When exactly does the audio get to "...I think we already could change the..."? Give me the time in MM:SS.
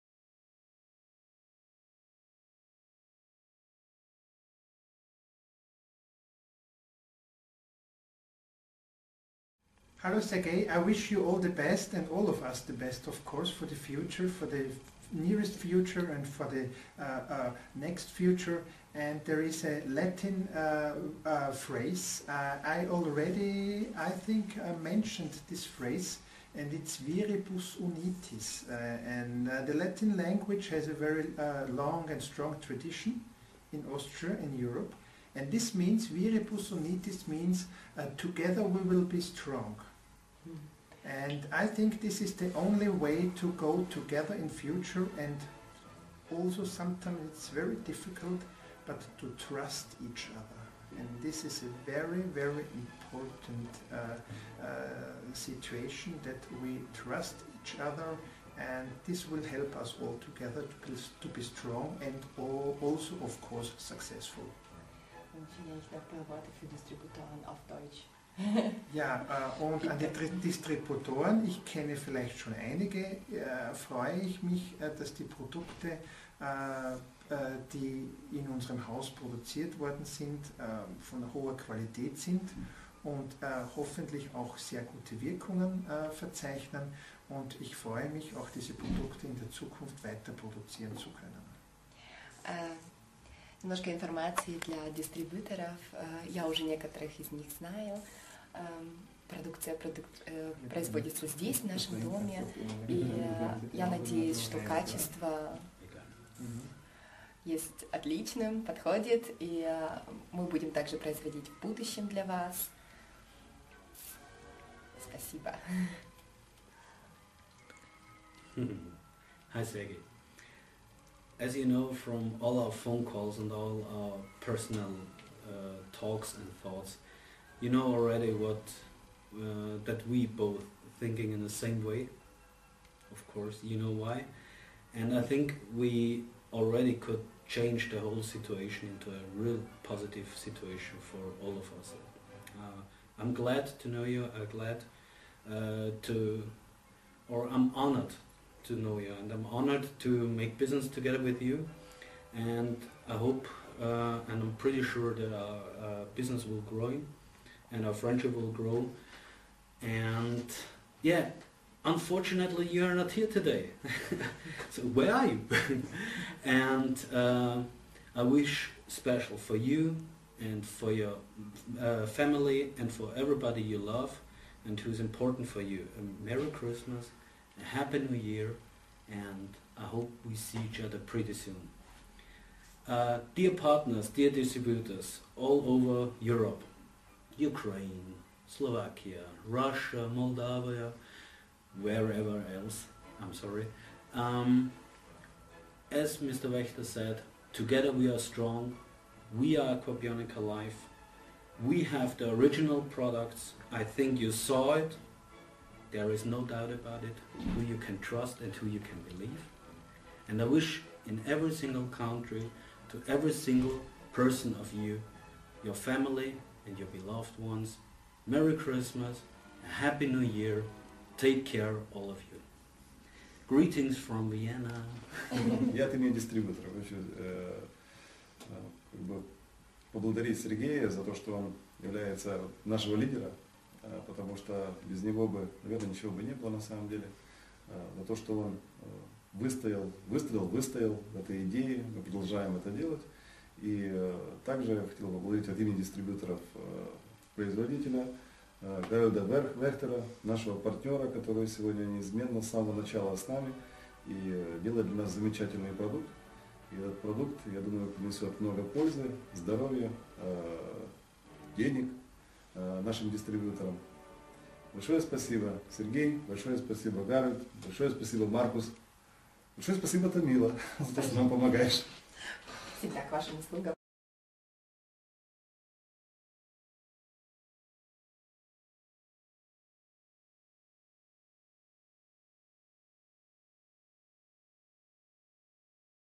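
02:15.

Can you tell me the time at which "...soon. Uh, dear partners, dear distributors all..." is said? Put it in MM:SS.
03:01.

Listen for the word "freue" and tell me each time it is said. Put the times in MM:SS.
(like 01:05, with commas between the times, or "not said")
01:13, 01:27.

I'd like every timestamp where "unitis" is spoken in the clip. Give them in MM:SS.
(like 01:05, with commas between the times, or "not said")
00:27, 00:36.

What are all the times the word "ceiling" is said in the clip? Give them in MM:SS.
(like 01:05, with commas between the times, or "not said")
not said.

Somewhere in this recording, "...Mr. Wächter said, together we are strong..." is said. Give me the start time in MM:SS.
03:16.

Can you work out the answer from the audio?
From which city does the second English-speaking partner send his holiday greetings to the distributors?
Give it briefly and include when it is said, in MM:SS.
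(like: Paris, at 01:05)
Vienna, at 03:44.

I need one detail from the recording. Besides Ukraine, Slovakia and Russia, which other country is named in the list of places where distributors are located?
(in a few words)
Moldova.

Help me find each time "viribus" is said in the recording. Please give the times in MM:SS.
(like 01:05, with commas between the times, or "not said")
00:26, 00:36.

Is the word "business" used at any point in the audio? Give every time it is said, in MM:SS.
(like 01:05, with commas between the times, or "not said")
02:30, 02:36.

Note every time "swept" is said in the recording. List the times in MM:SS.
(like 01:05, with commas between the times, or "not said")
not said.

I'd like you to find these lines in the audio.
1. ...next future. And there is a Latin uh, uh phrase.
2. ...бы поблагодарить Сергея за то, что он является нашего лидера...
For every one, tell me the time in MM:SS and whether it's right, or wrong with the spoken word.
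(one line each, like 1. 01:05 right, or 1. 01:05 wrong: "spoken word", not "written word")
1. 00:17 right
2. 03:49 right.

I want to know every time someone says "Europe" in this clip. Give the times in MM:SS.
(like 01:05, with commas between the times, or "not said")
00:34, 03:06.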